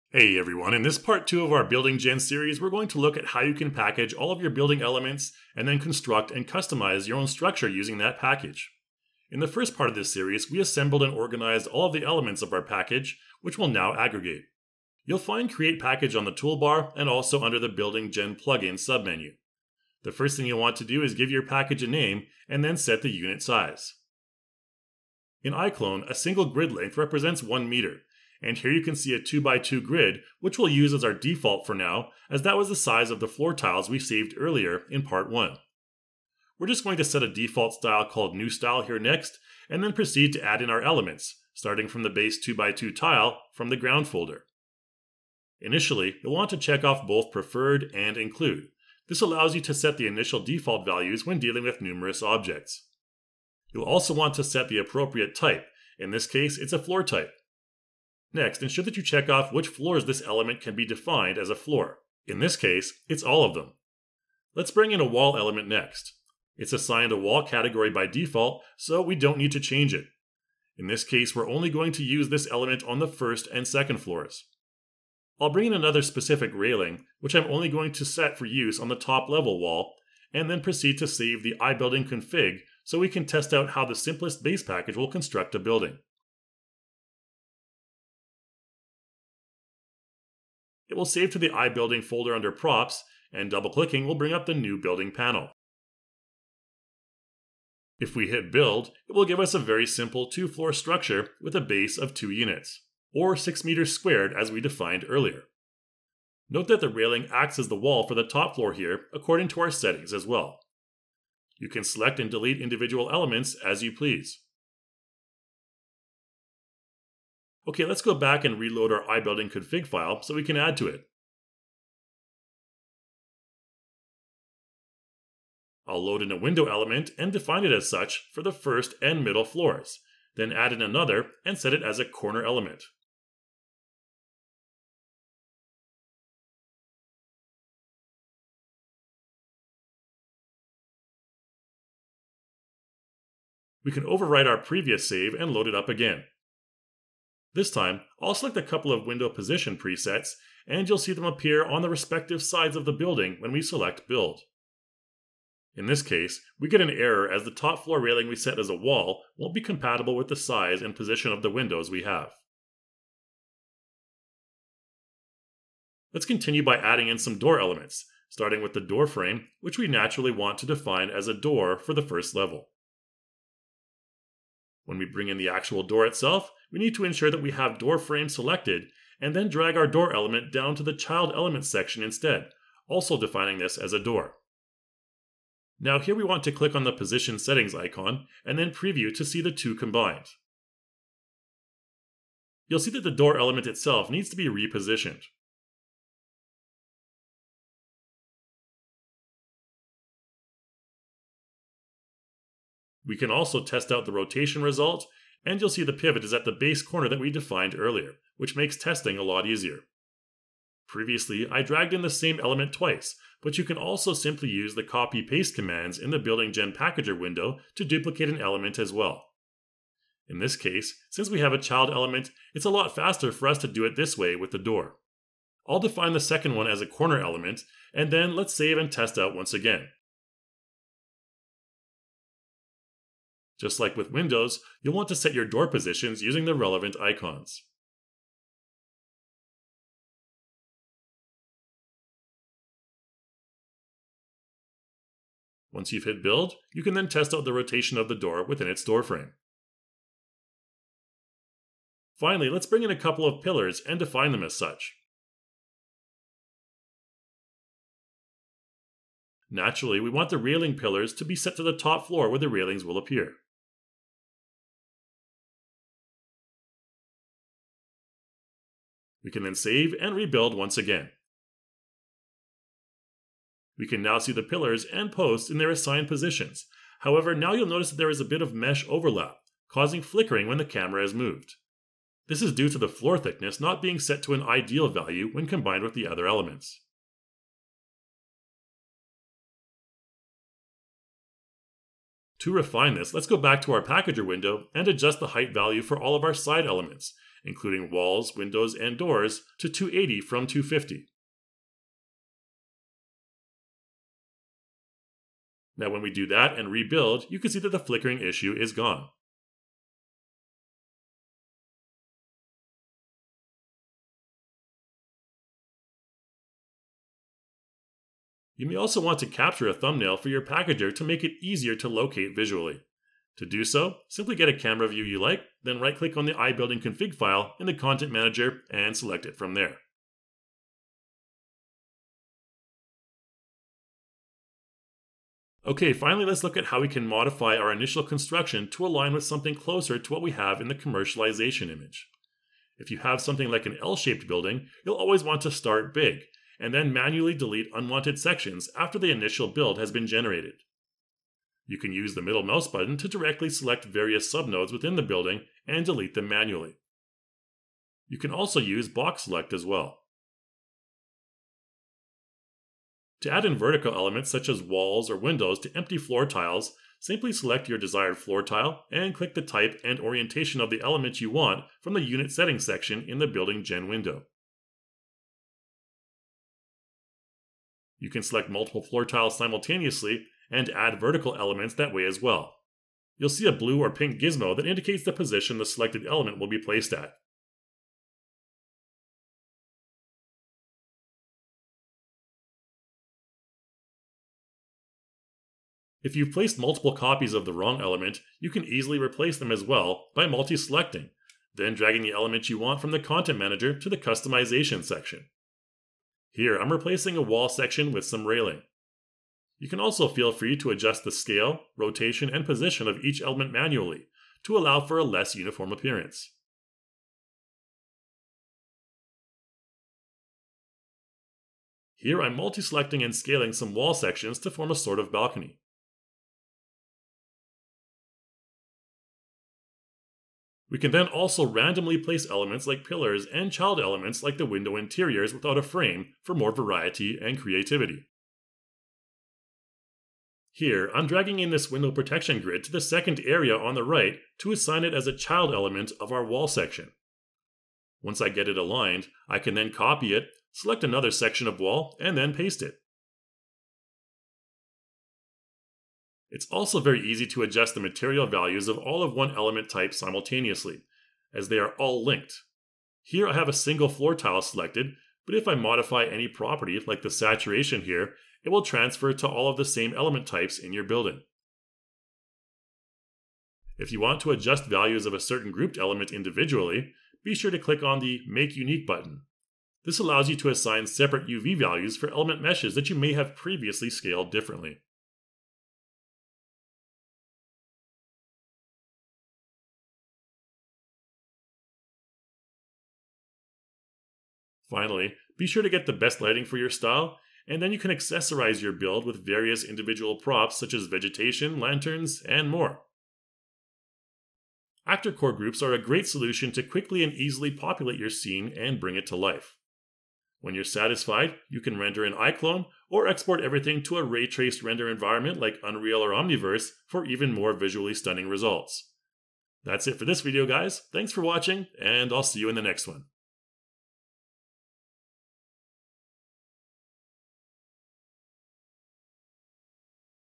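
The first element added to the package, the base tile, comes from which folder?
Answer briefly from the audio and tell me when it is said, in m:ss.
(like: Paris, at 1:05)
ground folder, at 0:43.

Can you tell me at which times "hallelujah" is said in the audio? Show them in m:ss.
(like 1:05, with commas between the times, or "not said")
not said.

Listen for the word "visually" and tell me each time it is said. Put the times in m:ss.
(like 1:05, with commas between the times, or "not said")
5:22, 8:37.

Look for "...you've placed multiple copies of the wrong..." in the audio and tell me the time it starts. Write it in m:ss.
6:36.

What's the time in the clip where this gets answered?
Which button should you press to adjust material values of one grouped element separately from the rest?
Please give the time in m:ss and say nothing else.
7:58.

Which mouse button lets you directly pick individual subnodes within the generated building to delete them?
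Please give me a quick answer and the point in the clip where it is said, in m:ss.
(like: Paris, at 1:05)
middle mouse button, at 5:52.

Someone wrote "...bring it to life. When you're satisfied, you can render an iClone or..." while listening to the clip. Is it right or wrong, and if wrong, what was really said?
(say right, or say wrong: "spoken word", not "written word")
right.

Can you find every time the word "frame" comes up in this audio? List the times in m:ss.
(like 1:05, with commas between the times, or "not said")
2:49, 2:57, 4:09, 7:15.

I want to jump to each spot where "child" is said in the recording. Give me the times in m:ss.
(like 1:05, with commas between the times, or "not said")
3:00, 3:41, 7:13, 7:25.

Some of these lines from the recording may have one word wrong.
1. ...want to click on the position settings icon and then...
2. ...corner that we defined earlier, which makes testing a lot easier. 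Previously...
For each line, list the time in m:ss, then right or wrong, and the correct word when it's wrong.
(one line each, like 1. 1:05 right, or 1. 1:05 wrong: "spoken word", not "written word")
1. 3:06 right
2. 3:26 right.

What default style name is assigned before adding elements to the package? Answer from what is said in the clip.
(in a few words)
new style.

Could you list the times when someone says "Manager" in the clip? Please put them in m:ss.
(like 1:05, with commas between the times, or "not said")
5:28, 6:43.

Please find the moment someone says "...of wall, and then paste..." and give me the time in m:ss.
7:31.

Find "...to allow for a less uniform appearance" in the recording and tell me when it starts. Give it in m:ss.
6:54.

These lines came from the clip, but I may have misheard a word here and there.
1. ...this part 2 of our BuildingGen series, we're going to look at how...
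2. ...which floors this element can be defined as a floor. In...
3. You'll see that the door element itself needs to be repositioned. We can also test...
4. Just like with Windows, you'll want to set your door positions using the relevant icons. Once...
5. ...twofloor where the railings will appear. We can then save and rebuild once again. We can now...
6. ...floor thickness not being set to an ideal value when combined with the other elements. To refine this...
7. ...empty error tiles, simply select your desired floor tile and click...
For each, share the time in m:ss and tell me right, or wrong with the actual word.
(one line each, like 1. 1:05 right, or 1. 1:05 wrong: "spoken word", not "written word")
1. 0:00 right
2. 0:59 right
3. 3:12 right
4. 3:53 right
5. 4:22 wrong: "floor", not "twofloor"
6. 4:42 right
7. 6:05 wrong: "floor", not "error".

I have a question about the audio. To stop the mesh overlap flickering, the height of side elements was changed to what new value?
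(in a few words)
280.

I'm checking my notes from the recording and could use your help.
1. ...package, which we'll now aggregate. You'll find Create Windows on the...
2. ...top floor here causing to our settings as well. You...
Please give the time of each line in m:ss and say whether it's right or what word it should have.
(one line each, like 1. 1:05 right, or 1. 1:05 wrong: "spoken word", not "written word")
1. 0:12 wrong: "Package", not "Windows"
2. 1:48 wrong: "according", not "causing".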